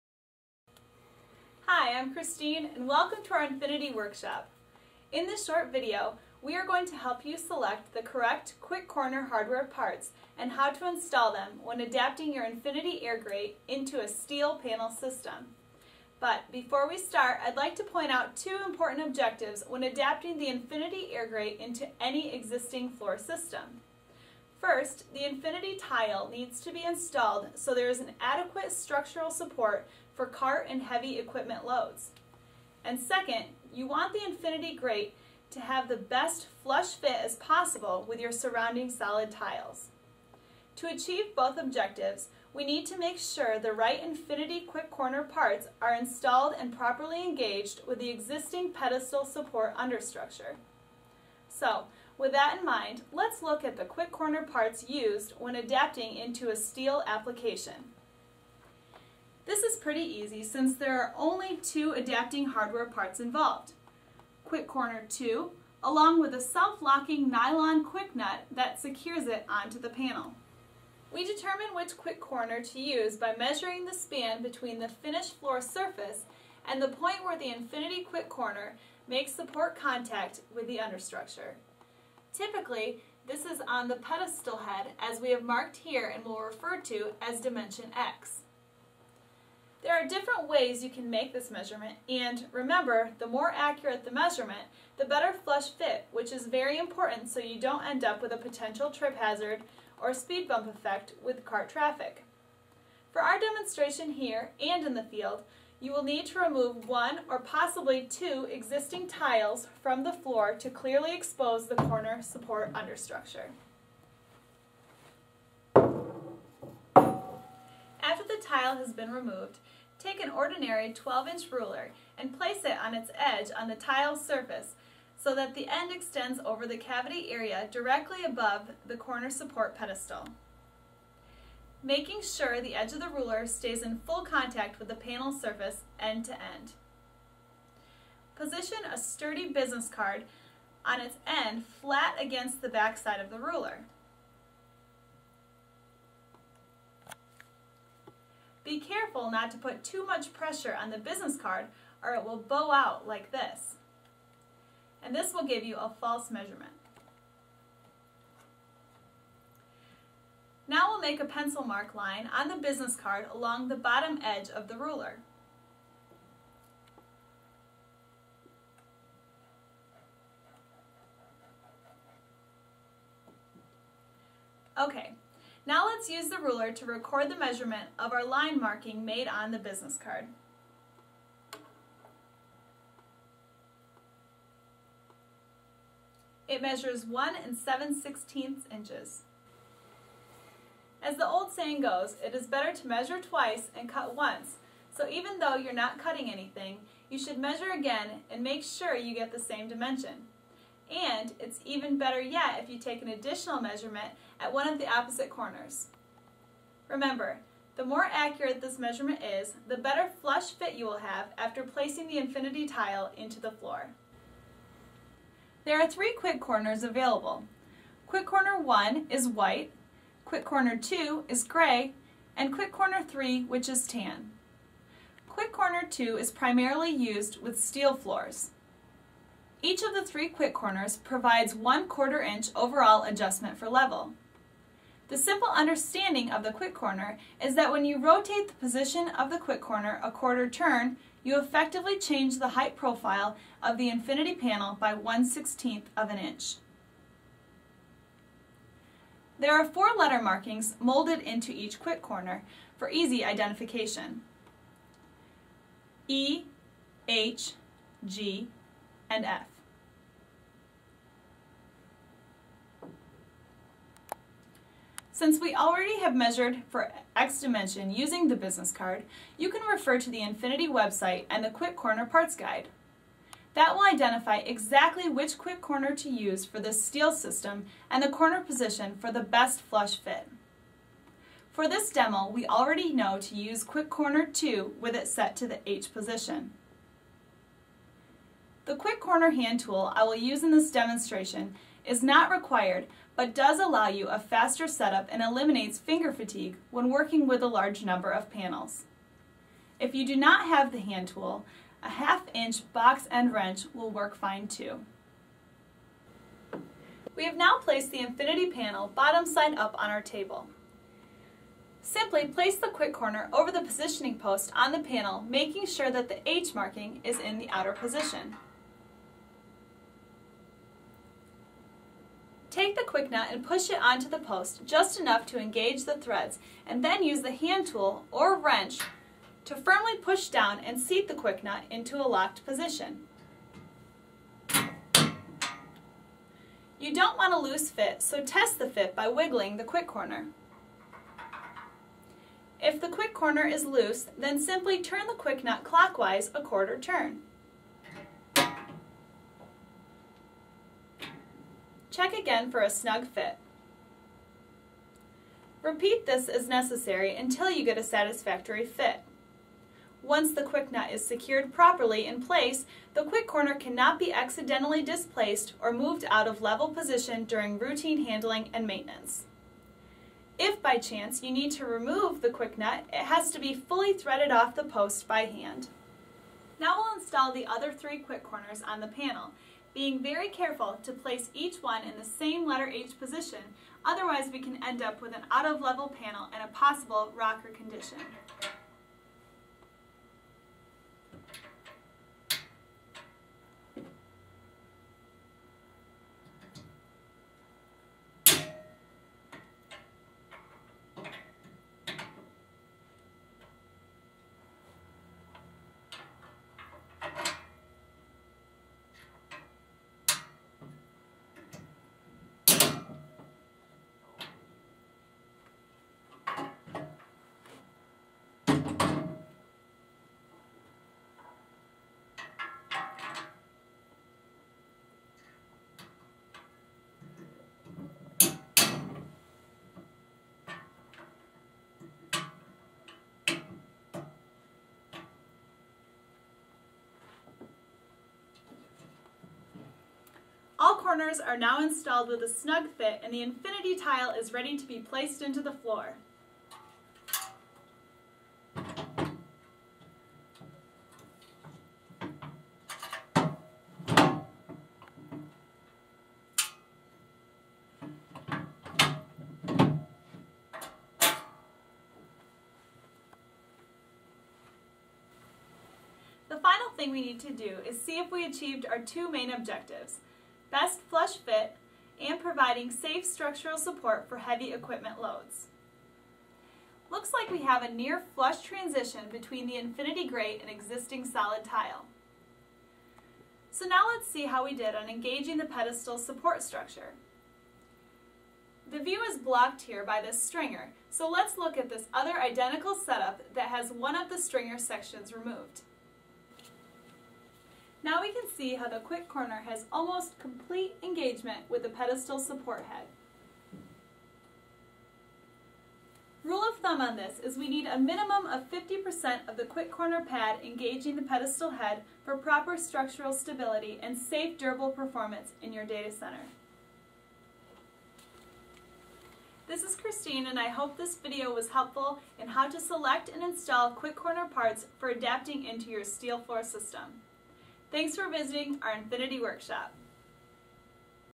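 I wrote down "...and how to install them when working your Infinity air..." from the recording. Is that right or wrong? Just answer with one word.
wrong.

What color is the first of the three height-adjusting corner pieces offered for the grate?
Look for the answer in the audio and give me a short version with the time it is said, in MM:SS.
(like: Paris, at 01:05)
white, at 03:39.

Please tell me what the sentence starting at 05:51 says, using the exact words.
Check again for a snug fit.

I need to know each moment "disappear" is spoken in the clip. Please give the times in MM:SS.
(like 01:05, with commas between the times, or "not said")
not said.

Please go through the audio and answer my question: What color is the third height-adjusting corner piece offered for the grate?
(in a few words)
tan.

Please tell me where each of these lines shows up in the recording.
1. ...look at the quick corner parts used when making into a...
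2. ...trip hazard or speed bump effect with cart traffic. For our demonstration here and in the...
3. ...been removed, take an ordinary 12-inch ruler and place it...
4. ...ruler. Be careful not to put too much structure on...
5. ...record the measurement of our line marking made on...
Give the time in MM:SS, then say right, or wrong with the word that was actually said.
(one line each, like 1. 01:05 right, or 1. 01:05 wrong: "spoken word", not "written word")
1. 00:53 wrong: "adapting", not "making"
2. 01:38 right
3. 01:58 right
4. 02:23 wrong: "pressure", not "structure"
5. 02:56 right.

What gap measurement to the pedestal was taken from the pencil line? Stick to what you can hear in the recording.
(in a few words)
1 7/16 inches.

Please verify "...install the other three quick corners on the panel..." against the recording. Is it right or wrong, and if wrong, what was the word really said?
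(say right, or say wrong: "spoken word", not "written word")
right.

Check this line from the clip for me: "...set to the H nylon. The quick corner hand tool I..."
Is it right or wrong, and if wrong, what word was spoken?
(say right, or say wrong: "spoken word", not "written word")
wrong: "position", not "nylon".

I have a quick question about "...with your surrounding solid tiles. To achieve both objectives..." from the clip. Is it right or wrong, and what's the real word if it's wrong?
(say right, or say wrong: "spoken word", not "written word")
right.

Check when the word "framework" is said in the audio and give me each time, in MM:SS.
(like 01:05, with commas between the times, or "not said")
not said.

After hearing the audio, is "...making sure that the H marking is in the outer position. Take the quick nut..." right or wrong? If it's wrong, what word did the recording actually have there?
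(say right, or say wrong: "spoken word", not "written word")
right.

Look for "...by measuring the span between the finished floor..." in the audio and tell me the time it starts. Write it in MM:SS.
01:13.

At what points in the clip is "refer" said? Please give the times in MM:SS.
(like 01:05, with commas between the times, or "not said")
01:26, 04:29.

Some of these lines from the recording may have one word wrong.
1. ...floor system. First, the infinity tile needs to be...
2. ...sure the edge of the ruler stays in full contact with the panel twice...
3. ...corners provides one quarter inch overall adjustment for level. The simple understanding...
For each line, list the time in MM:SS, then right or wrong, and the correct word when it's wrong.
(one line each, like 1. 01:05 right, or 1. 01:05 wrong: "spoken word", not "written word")
1. 00:22 right
2. 02:12 wrong: "surface", not "twice"
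3. 03:50 right.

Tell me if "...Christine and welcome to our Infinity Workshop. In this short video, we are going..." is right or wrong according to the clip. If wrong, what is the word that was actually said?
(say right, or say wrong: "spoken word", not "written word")
right.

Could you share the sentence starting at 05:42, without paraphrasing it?
If the quick corner is loose, then simply turn the quick nut clockwise a quarter turn.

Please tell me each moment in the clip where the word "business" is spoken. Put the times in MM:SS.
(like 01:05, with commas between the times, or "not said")
02:19, 02:30, 02:42, 02:59, 04:28.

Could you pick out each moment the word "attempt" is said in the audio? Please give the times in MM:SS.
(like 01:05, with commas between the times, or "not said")
not said.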